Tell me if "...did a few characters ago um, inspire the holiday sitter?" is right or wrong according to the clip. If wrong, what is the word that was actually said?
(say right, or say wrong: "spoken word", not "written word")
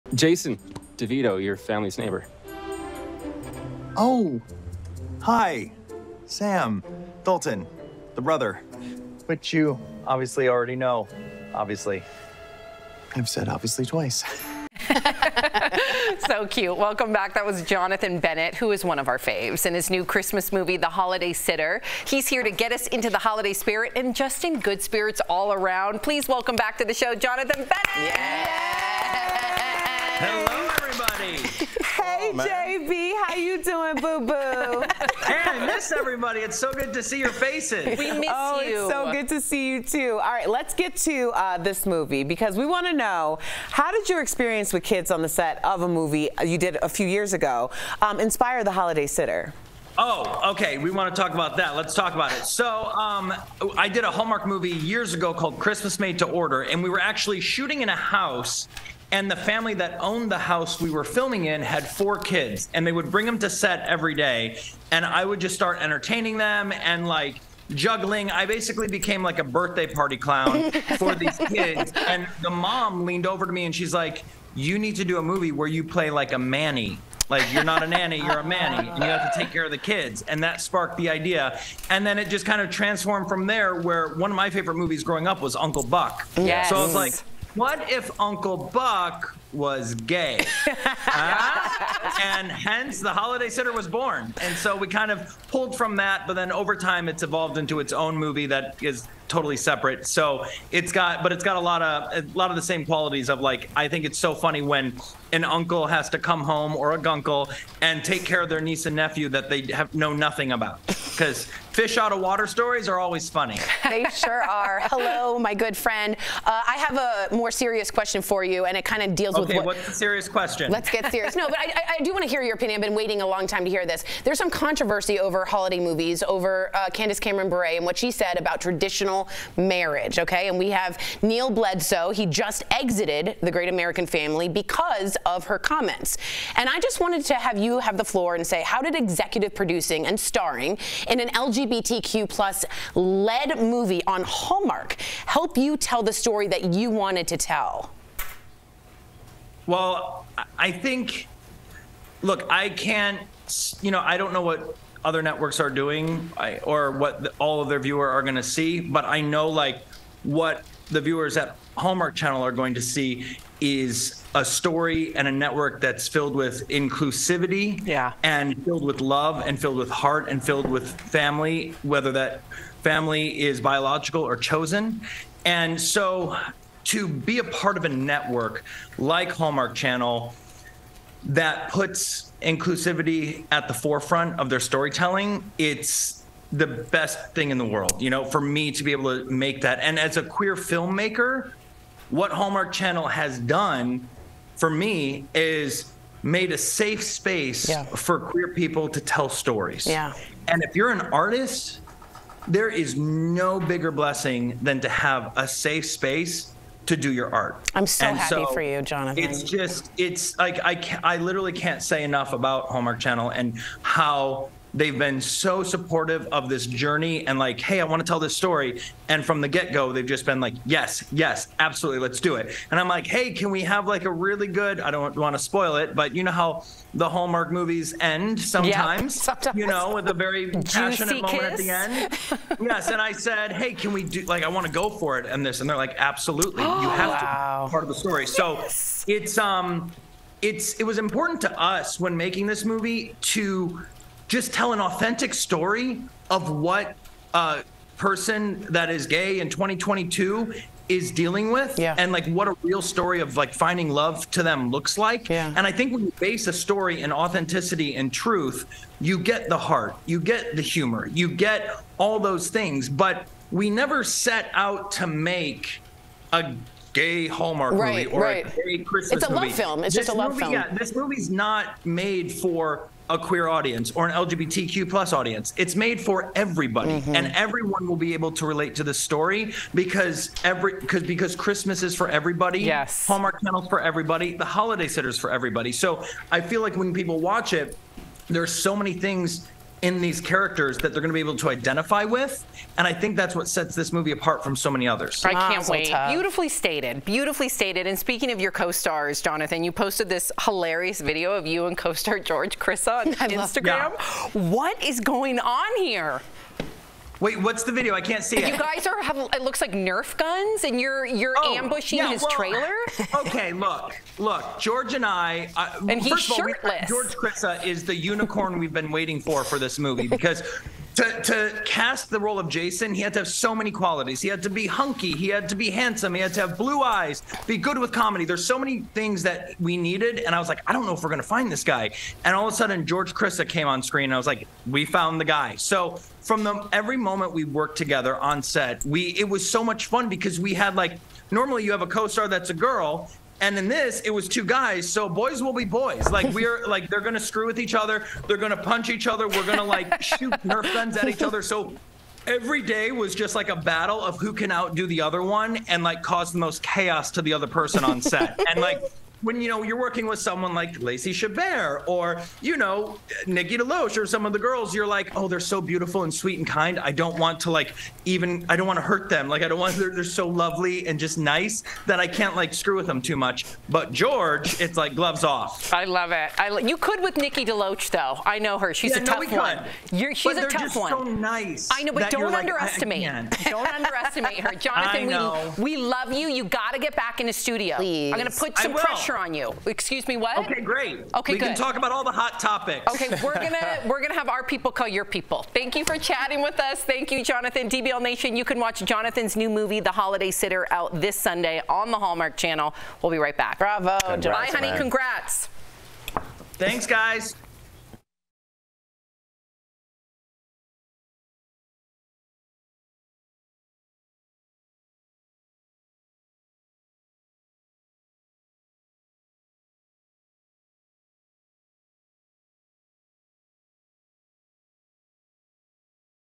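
wrong: "years", not "characters".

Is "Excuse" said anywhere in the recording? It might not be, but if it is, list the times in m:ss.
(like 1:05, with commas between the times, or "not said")
6:29.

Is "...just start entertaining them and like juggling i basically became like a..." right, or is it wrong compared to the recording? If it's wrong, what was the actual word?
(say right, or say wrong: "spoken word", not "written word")
right.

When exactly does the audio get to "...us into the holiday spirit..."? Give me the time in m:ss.
0:22.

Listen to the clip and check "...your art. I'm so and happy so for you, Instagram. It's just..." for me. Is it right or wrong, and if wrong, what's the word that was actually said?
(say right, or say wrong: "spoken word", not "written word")
wrong: "Jonathan", not "Instagram".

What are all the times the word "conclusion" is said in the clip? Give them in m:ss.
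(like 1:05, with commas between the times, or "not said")
not said.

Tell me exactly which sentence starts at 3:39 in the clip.
And from the get go, they've just been like, yes, yes, absolutely, let's do it.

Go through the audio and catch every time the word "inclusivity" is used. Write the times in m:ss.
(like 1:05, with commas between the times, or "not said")
2:46, 3:02.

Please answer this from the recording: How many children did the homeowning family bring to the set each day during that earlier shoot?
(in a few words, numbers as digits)
4.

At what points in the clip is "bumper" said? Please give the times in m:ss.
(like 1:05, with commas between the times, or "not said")
not said.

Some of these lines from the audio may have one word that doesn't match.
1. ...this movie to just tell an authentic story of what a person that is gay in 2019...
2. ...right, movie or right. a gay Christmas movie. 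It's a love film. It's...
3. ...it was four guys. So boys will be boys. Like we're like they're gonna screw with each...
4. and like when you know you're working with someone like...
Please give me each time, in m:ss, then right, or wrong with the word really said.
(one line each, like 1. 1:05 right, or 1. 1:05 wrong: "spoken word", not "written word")
1. 4:02 wrong: "2022", not "2019"
2. 4:27 right
3. 5:44 wrong: "two", not "four"
4. 5:58 right.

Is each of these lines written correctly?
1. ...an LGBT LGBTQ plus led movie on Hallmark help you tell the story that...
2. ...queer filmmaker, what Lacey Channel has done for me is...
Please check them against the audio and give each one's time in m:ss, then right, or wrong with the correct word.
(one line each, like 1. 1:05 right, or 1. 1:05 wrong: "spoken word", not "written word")
1. 2:21 right
2. 3:10 wrong: "Hallmark", not "Lacey".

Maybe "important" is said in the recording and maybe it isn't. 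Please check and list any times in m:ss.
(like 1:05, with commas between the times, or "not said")
4:00.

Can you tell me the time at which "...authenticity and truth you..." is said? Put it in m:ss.
4:17.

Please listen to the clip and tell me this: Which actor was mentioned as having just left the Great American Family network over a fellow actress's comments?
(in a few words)
Neal Bledsoe.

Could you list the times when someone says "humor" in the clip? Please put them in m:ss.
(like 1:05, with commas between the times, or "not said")
4:20.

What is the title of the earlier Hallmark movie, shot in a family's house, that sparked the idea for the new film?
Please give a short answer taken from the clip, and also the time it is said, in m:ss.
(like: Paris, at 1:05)
Christmas Made to Order, at 0:55.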